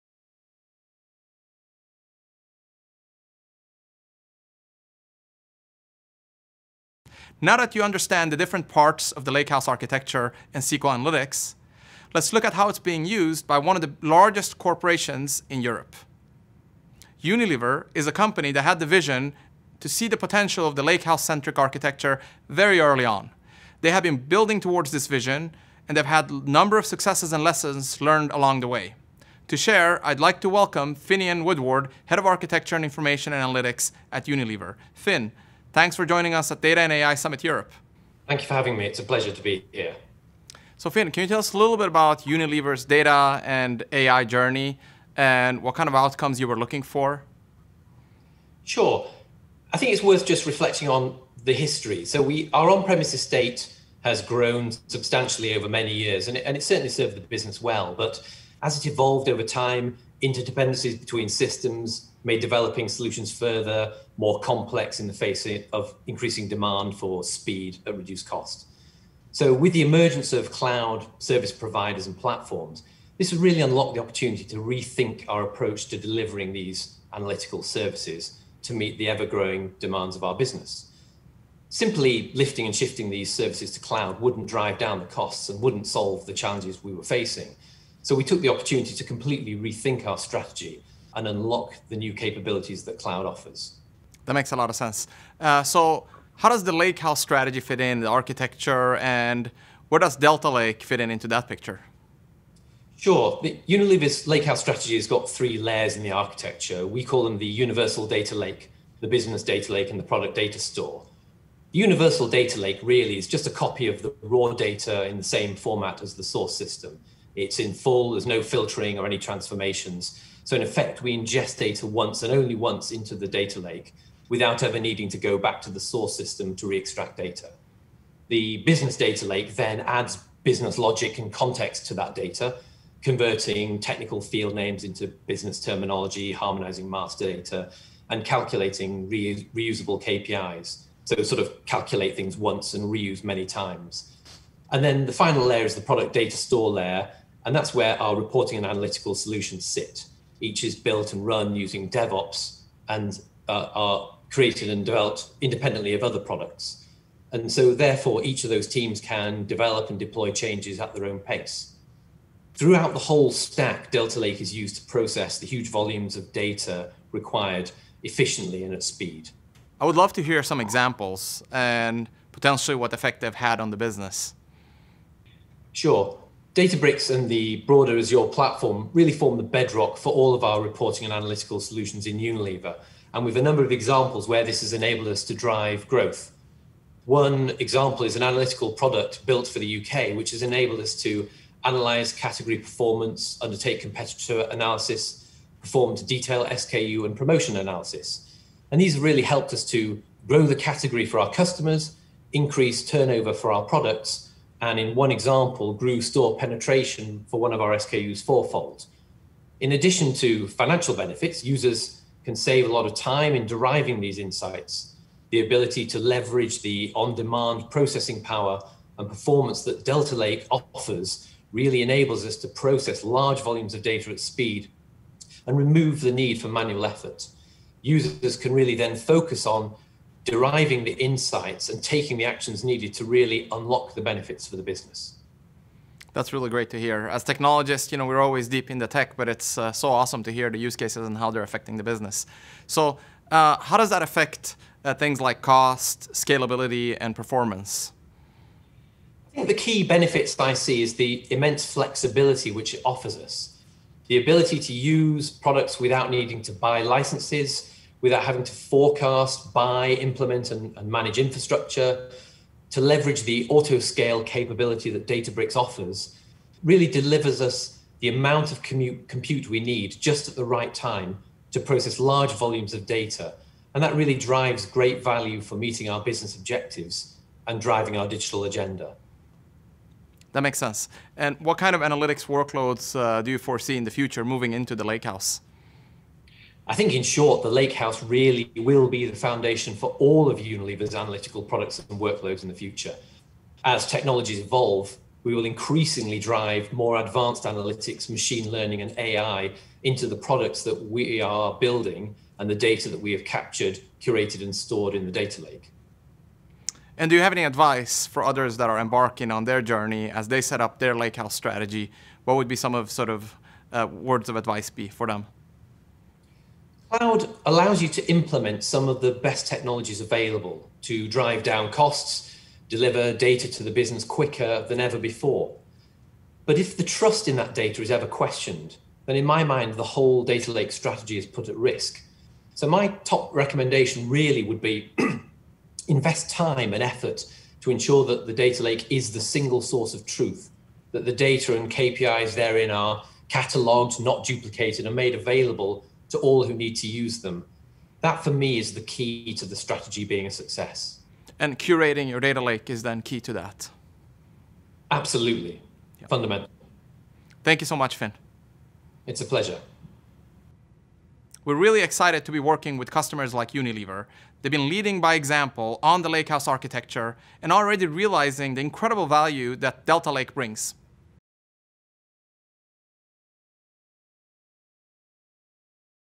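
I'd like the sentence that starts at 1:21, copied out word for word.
Simply lifting and shifting these services to cloud wouldn't drive down the costs and wouldn't solve the challenges we were facing.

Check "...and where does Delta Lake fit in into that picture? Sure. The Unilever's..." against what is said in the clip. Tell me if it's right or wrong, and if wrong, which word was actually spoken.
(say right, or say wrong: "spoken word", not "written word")
right.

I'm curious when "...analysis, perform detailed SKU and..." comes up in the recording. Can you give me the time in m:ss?
3:14.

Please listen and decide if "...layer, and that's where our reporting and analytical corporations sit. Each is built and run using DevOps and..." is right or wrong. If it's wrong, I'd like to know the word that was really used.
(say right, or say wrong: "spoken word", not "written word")
wrong: "solutions", not "corporations".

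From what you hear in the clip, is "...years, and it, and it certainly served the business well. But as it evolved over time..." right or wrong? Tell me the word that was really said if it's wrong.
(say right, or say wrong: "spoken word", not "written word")
right.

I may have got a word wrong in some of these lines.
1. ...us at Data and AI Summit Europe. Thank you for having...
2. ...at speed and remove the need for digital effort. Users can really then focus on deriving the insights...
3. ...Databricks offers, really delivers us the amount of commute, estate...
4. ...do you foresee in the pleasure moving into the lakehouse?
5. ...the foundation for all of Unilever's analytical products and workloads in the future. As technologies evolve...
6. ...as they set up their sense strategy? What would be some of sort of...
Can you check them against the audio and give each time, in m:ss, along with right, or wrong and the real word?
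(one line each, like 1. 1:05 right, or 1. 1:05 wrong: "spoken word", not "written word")
1. 0:36 right
2. 3:44 wrong: "manual", not "digital"
3. 4:25 wrong: "compute", not "estate"
4. 4:43 wrong: "future", not "pleasure"
5. 4:49 right
6. 5:10 wrong: "lakehouse", not "sense".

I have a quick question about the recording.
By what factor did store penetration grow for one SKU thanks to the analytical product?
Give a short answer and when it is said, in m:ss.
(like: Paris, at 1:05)
fourfold, at 3:28.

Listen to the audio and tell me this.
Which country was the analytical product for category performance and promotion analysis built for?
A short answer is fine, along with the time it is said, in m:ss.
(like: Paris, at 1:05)
UK, at 3:09.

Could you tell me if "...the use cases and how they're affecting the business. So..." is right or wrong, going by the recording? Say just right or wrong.
right.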